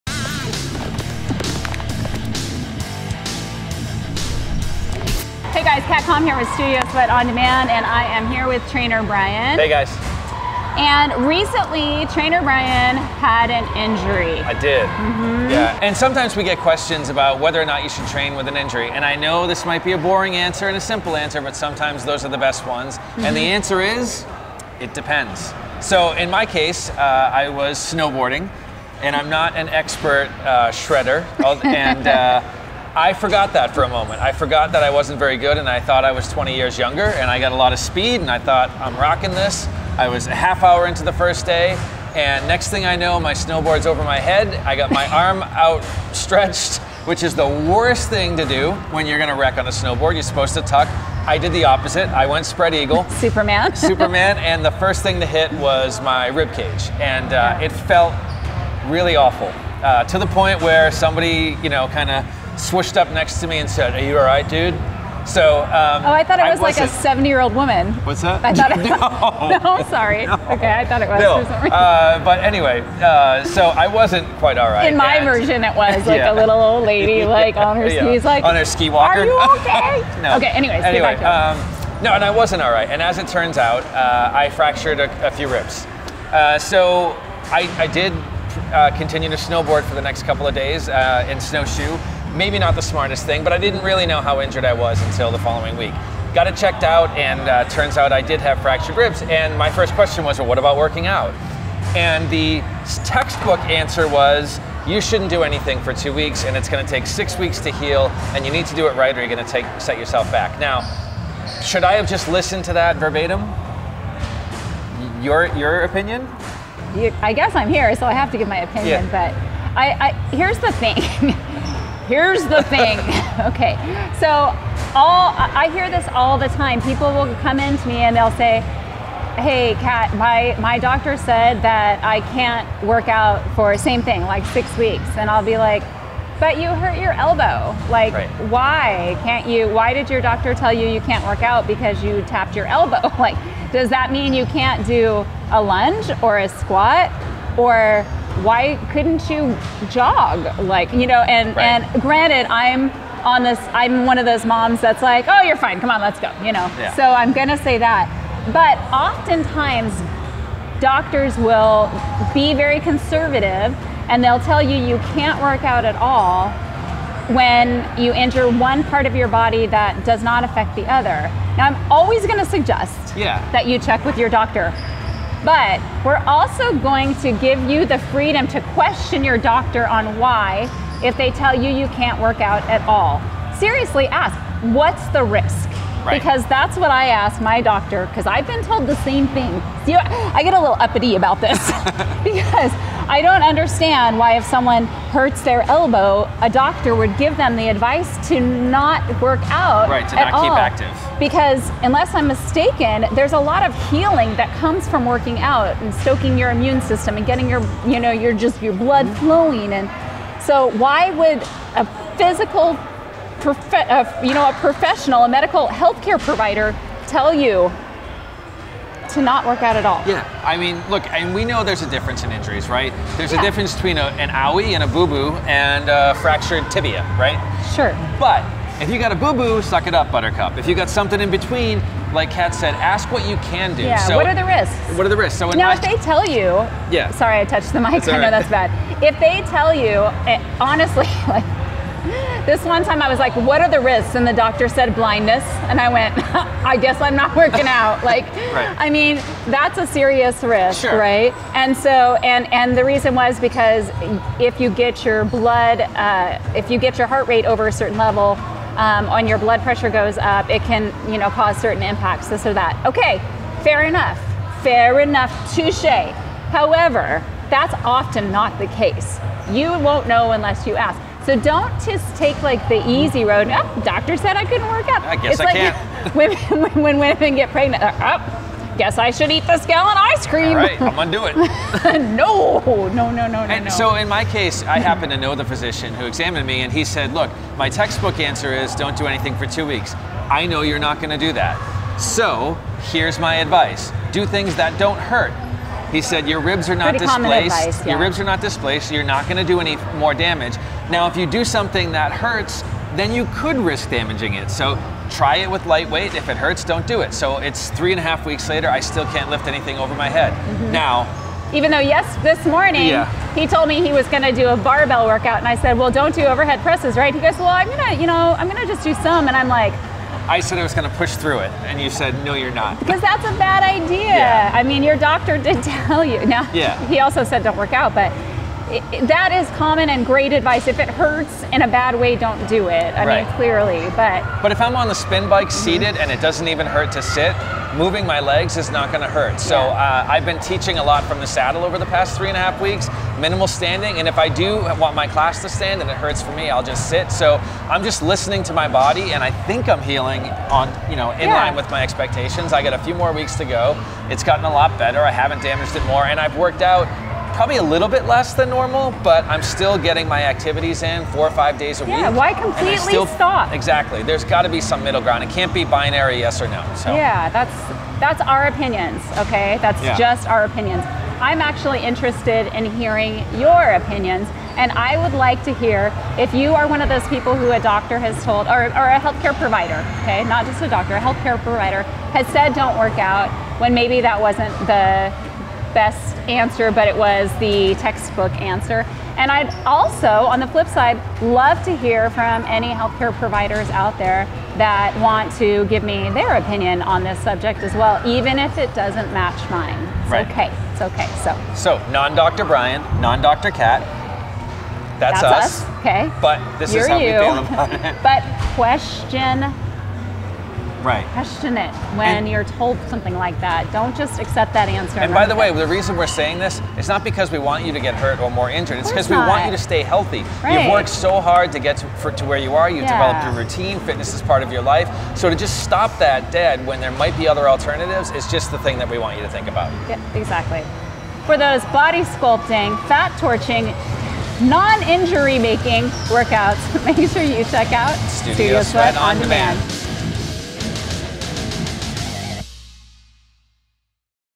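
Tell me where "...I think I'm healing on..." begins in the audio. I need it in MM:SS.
05:49.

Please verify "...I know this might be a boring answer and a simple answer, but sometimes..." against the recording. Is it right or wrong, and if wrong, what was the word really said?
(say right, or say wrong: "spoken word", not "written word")
right.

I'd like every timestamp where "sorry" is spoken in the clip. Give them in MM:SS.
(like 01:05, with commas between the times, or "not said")
01:09, 03:57.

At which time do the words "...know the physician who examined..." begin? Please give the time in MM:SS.
04:45.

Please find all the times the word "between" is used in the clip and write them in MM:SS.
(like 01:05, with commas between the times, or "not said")
03:43, 03:51.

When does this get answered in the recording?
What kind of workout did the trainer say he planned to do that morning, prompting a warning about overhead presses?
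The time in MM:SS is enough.
05:14.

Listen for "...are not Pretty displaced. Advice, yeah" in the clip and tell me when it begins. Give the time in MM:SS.
04:56.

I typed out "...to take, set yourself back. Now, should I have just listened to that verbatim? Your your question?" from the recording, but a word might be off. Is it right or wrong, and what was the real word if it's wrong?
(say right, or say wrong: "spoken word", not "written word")
wrong: "opinion", not "question".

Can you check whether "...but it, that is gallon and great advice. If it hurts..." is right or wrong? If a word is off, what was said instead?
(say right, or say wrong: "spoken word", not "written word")
wrong: "common", not "gallon".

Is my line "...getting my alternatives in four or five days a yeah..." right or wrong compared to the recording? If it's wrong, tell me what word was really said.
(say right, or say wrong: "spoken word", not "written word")
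wrong: "activities", not "alternatives".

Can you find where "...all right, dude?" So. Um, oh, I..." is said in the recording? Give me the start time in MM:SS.
01:04.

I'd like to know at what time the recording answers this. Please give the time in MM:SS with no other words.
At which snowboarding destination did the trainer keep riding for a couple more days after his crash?
01:31.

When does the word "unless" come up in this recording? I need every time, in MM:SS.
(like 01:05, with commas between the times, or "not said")
03:21, 04:30.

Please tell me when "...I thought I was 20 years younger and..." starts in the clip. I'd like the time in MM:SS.
00:35.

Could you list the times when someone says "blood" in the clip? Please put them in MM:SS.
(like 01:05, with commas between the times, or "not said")
03:28, 04:15, 04:19.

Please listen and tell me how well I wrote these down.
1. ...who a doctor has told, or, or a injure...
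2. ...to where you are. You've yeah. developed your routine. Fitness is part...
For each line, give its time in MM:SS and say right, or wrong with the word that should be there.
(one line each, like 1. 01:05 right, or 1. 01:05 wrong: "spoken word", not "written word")
1. 06:17 wrong: "healthcare", not "injure"
2. 07:02 right.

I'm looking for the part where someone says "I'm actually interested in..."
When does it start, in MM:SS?
06:11.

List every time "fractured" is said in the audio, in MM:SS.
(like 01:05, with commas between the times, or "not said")
01:24, 01:38, 03:46.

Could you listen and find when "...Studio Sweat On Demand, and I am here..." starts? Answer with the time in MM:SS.
00:06.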